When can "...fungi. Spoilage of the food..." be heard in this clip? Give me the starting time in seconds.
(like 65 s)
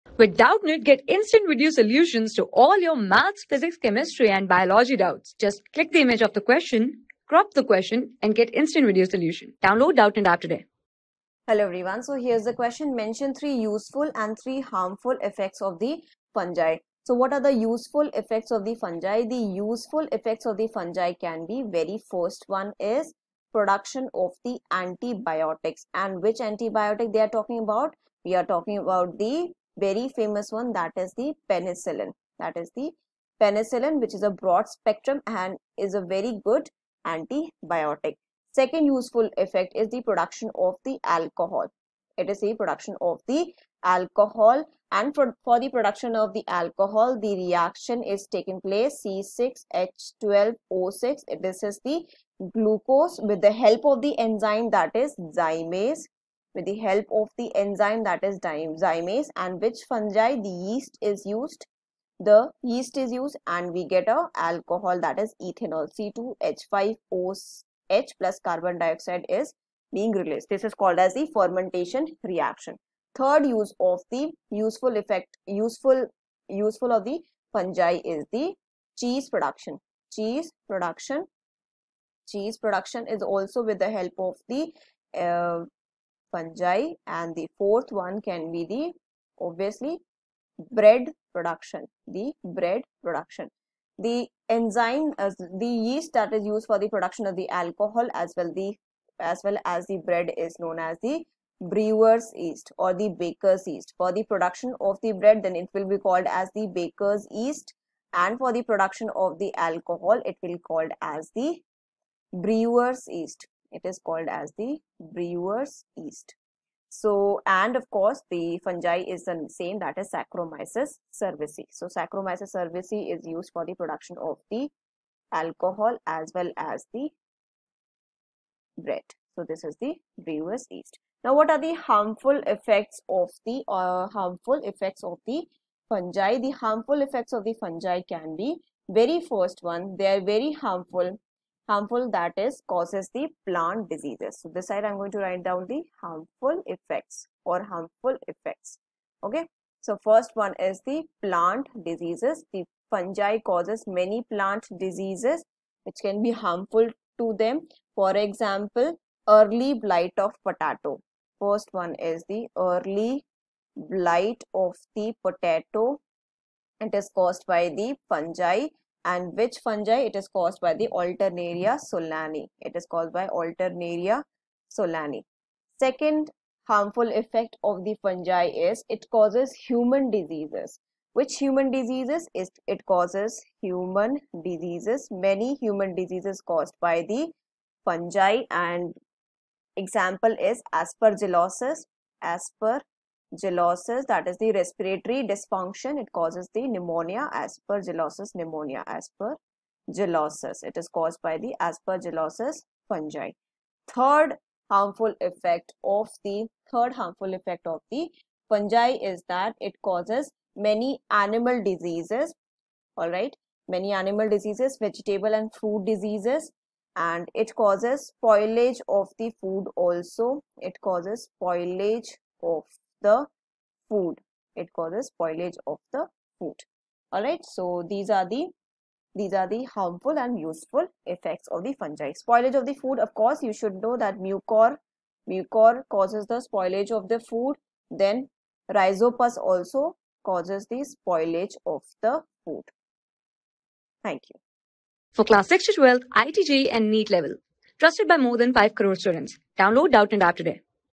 231 s.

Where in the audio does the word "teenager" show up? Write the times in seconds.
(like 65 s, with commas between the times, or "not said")
not said.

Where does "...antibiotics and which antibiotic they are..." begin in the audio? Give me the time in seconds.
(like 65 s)
24 s.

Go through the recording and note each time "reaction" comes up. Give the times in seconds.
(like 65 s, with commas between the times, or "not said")
47 s, 72 s.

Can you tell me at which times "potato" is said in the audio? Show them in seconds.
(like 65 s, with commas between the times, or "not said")
160 s, 165 s.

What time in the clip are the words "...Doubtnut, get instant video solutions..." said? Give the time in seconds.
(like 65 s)
0 s.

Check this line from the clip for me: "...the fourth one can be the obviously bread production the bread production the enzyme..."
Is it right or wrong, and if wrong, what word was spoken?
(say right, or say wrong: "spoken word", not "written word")
right.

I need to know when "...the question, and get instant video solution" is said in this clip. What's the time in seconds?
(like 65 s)
7 s.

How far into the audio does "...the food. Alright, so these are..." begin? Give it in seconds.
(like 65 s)
225 s.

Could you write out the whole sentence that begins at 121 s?
So, Saccharomyces cerevisiae is used for the production of the alcohol as well as the bread.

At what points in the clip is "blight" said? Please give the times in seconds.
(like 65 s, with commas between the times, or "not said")
159 s, 163 s.